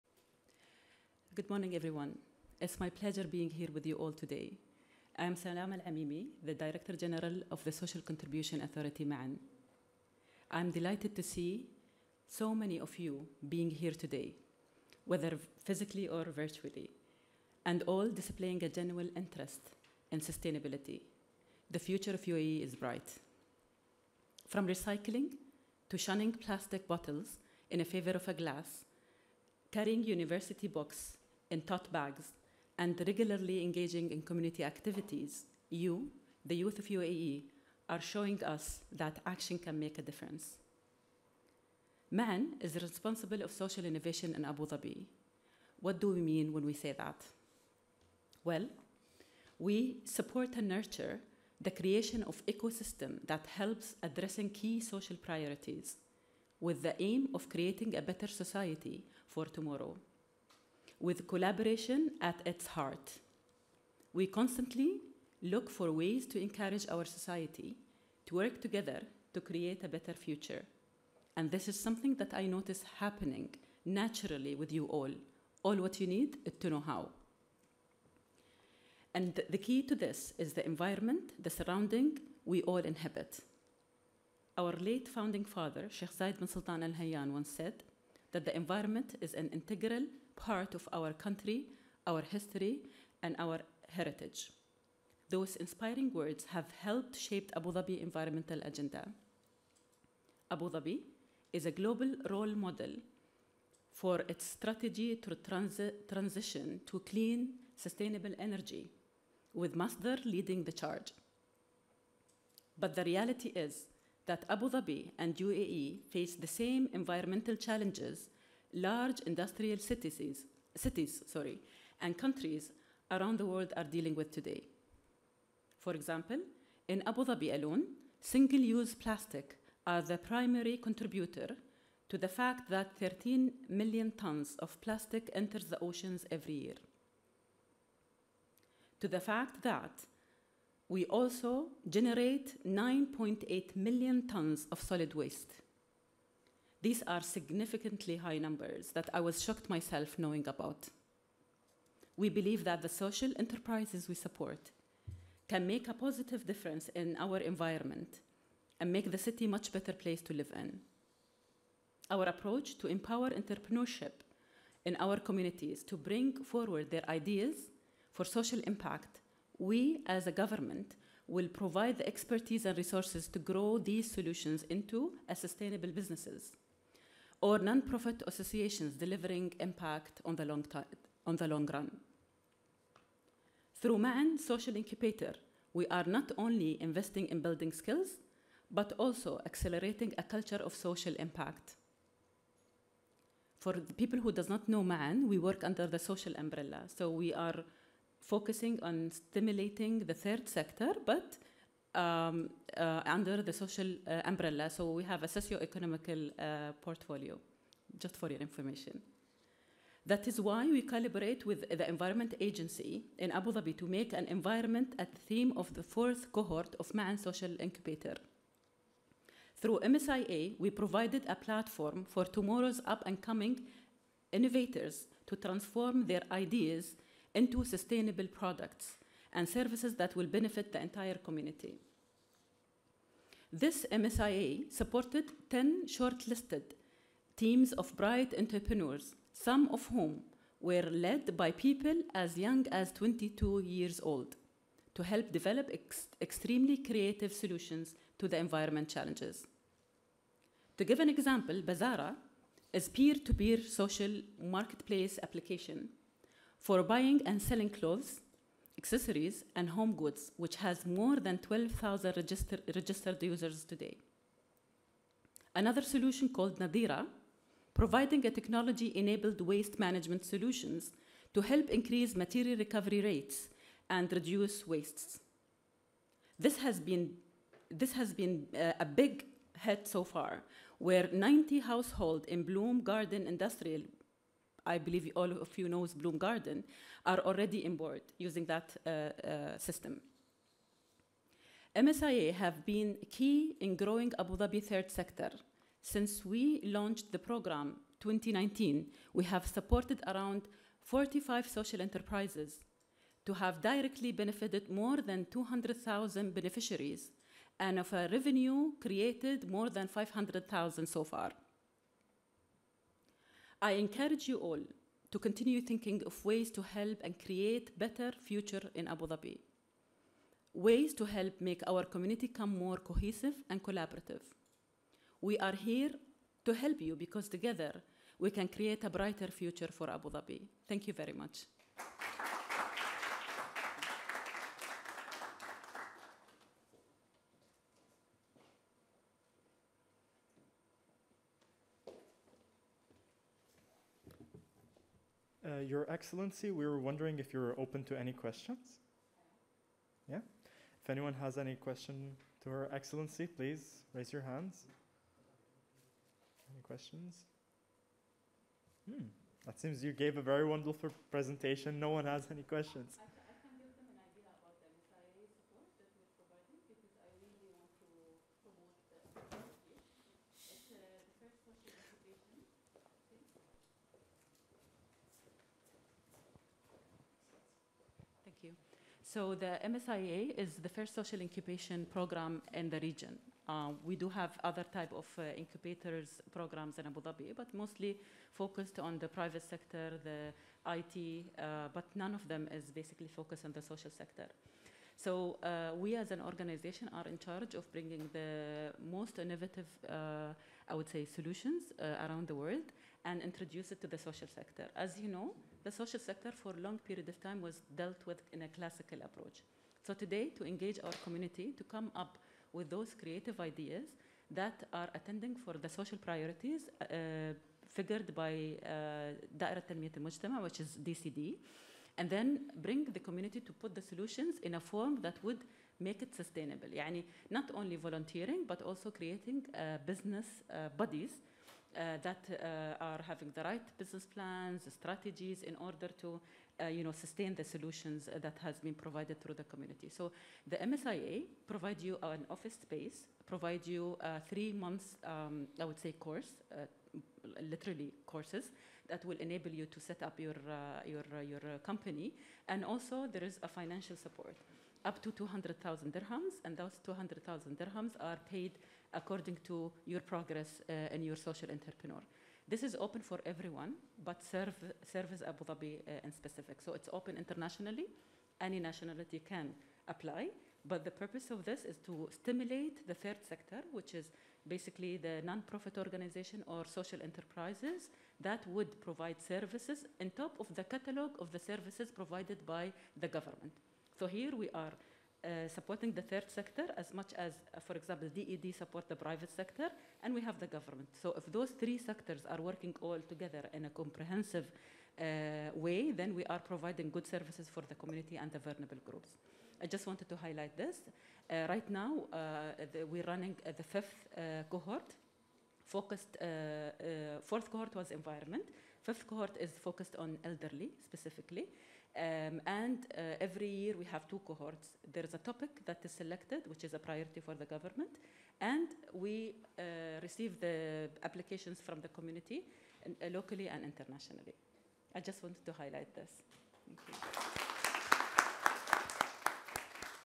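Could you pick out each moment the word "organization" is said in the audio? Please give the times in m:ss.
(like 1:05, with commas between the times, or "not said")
6:36, 7:55.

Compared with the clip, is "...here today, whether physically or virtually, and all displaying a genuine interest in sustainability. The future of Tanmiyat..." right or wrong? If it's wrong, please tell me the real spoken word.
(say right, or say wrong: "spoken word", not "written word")
wrong: "UAE", not "Tanmiyat".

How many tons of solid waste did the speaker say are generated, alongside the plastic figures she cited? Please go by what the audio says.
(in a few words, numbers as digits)
9.8 million tons.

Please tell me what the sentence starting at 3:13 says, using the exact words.
For the people who does not know Ma'an, we work under the social umbrella.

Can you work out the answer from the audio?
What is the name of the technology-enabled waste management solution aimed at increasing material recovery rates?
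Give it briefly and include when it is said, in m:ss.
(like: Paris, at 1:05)
Nadira, at 4:26.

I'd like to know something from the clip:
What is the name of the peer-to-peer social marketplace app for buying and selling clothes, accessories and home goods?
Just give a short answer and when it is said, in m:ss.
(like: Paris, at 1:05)
Bazara, at 4:11.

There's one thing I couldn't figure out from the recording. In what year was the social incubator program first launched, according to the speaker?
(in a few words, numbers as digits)
2019.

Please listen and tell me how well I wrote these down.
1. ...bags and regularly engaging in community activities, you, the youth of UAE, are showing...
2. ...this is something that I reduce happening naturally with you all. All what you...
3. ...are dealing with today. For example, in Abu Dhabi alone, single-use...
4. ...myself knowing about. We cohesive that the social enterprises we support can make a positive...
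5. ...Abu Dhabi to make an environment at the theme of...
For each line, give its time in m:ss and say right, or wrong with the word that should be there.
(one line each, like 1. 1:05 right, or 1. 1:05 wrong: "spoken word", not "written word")
1. 0:31 right
2. 1:11 wrong: "notice", not "reduce"
3. 2:03 right
4. 2:29 wrong: "believe", not "cohesive"
5. 3:33 right.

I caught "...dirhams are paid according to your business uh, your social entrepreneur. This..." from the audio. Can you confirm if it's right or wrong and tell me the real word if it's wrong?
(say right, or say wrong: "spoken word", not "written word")
wrong: "progress", not "business".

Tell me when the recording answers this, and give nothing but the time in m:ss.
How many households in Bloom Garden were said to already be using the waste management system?
4:41.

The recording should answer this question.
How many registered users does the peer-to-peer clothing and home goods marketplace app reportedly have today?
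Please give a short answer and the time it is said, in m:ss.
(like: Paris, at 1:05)
12,000, at 4:21.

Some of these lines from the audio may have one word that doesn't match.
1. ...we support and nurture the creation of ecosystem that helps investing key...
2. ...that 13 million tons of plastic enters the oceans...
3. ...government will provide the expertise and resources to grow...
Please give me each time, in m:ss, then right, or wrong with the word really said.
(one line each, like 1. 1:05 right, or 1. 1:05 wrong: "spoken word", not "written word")
1. 0:49 wrong: "addressing", not "investing"
2. 2:12 right
3. 2:50 right.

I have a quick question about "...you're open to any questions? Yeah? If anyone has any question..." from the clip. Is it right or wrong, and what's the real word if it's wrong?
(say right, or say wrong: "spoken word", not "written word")
right.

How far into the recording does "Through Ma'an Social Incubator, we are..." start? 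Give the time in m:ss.
3:03.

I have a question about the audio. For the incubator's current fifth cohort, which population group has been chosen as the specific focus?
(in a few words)
elderly.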